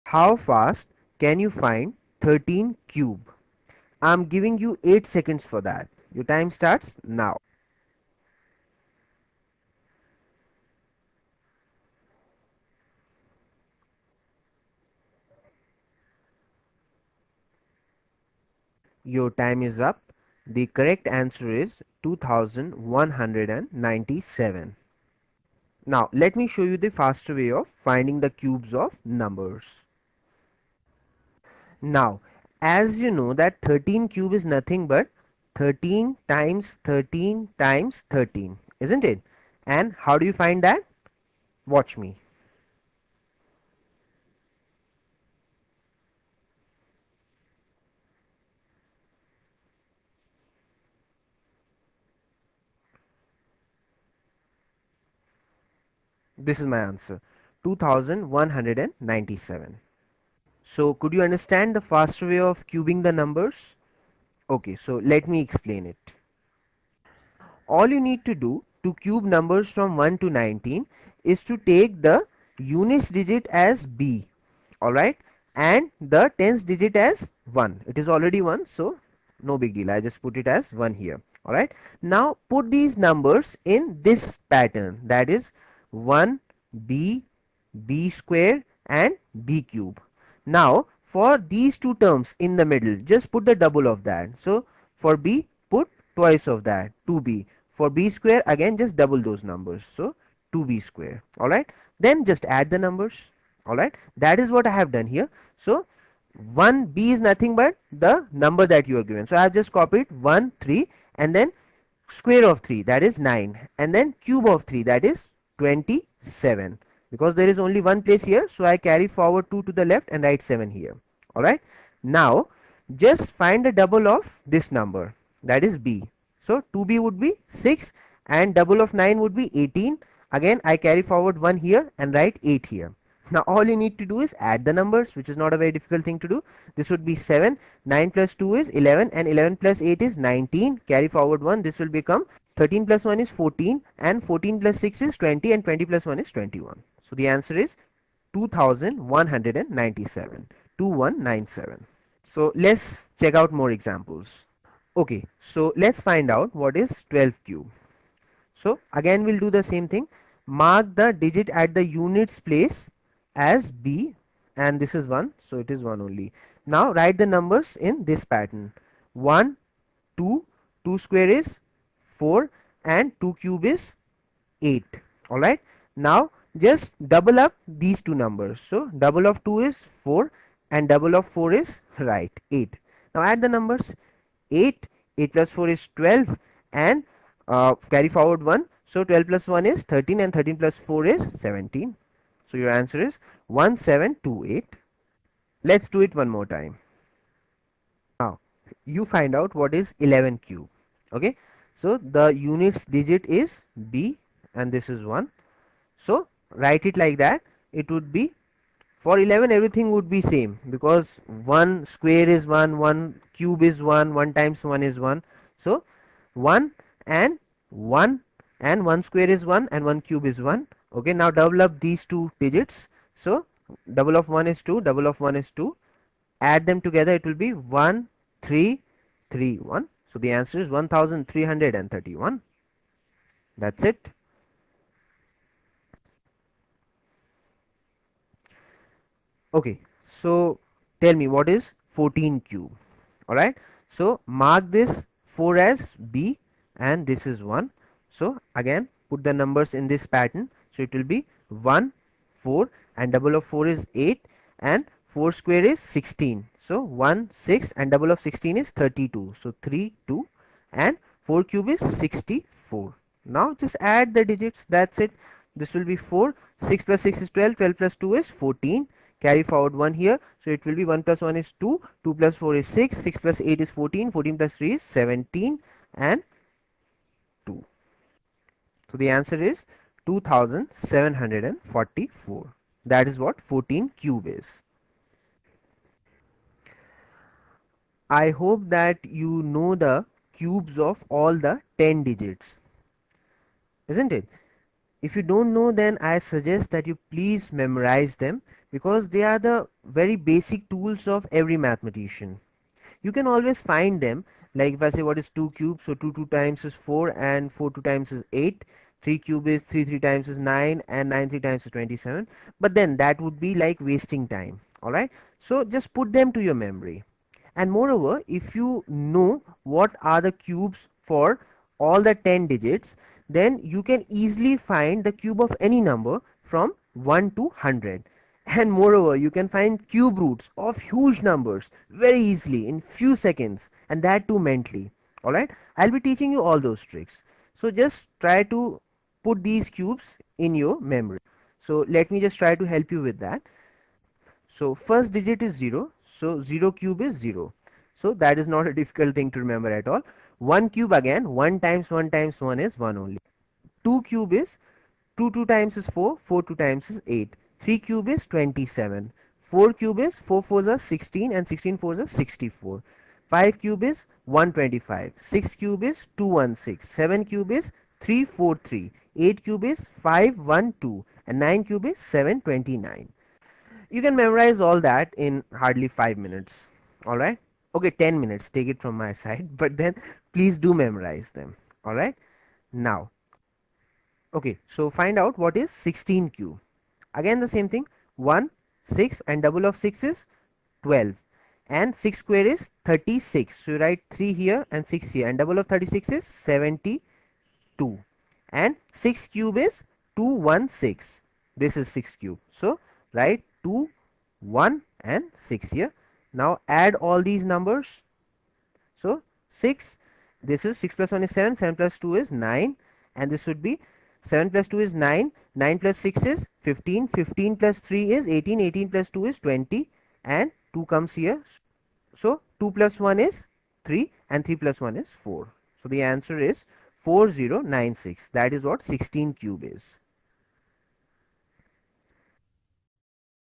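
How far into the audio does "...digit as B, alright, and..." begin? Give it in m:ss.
1:13.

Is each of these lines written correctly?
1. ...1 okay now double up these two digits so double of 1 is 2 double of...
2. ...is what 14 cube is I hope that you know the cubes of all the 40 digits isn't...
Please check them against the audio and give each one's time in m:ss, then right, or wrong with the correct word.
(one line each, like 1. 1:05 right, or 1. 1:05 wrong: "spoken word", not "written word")
1. 3:40 right
2. 4:43 wrong: "10", not "40".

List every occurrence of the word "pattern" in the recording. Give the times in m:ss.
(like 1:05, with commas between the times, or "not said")
1:24, 2:48, 4:10.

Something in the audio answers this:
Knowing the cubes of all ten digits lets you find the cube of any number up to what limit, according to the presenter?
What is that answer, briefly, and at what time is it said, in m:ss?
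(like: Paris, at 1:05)
100, at 5:27.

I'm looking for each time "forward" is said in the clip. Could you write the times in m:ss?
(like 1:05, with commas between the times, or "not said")
1:59, 2:11, 2:21, 3:08, 4:29.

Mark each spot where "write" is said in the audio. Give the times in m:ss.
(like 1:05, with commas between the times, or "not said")
2:00, 2:12, 2:46, 3:26, 6:33, 6:43.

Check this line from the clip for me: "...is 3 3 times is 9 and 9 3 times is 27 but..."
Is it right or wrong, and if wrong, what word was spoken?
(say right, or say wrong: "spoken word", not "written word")
right.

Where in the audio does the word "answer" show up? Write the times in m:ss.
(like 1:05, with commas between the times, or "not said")
0:21, 0:56, 2:27, 3:12, 3:50, 4:39, 7:06.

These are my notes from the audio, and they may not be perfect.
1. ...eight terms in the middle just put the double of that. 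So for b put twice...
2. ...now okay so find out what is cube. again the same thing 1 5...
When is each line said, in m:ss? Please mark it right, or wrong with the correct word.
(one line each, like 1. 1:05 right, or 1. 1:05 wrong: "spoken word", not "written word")
1. 1:31 wrong: "two", not "eight"
2. 6:22 wrong: "6", not "5".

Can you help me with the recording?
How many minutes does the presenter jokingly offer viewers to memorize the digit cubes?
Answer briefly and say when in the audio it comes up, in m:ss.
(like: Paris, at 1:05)
10 minutes, at 6:17.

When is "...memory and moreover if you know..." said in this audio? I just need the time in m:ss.
5:16.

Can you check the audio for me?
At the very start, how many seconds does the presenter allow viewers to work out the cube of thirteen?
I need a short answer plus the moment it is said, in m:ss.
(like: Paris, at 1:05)
8 seconds, at 0:04.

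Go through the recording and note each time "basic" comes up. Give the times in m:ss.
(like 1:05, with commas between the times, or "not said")
5:00.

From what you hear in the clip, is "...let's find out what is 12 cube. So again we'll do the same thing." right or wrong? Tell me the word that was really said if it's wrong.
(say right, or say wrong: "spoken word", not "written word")
right.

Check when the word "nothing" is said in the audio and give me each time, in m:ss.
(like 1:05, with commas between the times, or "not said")
0:34, 1:47.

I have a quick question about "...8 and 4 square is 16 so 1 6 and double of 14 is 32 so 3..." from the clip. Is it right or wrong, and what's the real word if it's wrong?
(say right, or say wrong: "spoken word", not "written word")
wrong: "16", not "14".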